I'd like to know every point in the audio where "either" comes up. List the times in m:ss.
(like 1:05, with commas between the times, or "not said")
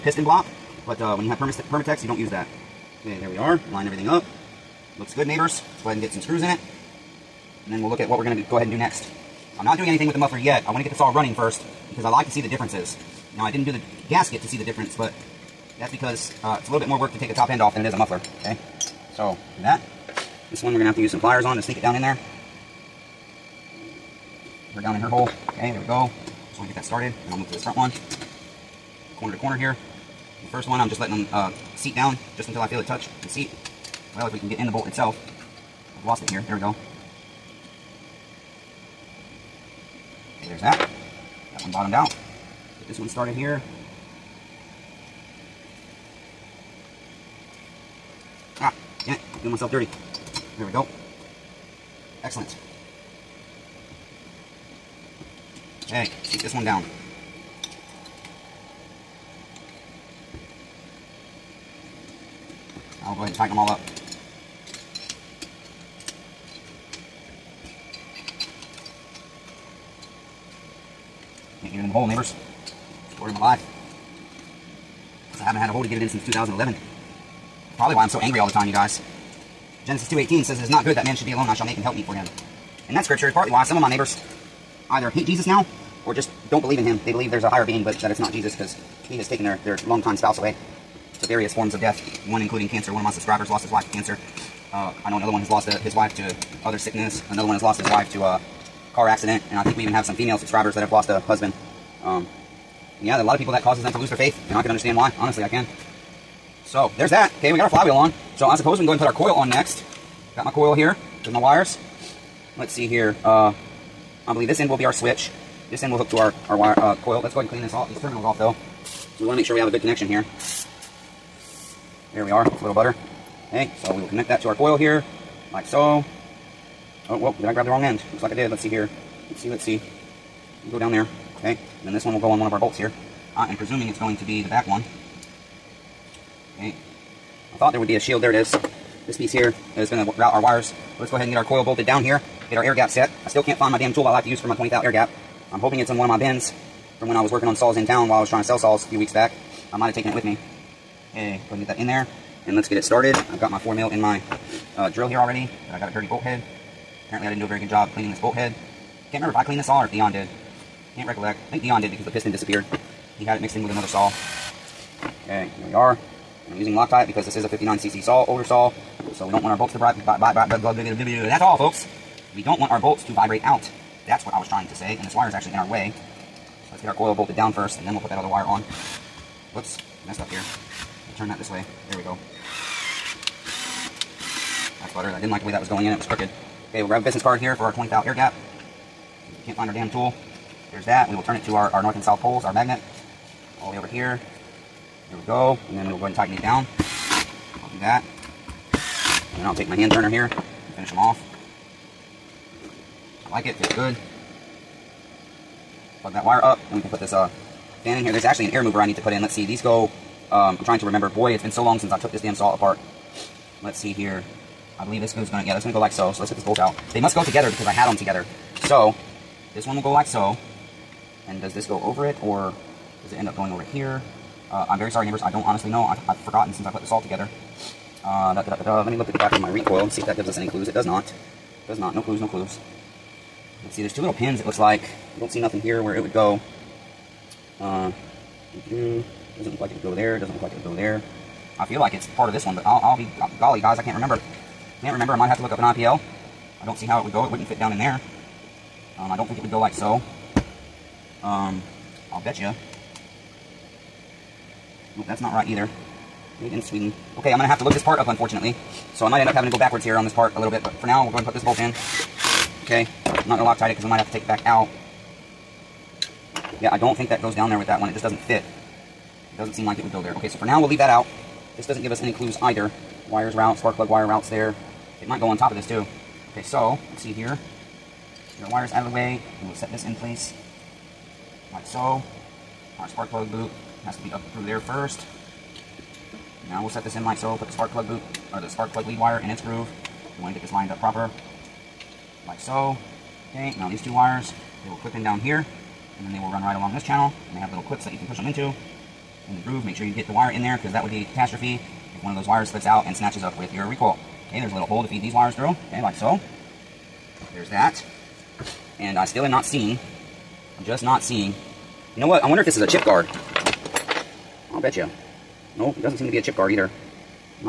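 1:24, 4:15, 4:32, 5:16.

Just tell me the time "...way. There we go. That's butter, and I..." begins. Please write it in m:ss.
3:01.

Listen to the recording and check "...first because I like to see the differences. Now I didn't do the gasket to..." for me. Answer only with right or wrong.
right.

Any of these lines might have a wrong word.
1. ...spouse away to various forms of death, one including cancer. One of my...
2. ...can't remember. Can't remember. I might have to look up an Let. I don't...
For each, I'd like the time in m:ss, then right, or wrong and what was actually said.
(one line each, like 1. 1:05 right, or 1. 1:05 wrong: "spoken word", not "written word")
1. 1:30 right
2. 4:03 wrong: "IPL", not "Let".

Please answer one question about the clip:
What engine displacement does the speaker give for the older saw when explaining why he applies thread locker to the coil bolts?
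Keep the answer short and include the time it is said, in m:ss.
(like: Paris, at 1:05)
59cc, at 2:47.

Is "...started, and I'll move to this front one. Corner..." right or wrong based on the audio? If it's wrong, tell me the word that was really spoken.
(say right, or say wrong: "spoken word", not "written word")
right.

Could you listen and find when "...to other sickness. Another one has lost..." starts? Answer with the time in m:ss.
1:36.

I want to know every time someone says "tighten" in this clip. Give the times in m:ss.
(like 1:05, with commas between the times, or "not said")
1:03, 3:16.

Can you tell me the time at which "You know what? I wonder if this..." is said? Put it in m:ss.
5:11.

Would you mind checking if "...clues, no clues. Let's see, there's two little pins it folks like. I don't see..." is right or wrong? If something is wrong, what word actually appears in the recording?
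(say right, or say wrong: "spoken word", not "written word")
wrong: "looks", not "folks".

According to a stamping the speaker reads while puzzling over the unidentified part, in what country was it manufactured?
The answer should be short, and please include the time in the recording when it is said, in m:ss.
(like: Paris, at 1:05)
Sweden, at 4:16.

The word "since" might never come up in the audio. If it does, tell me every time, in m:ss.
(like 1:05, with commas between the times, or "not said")
1:16, 3:31, 3:46.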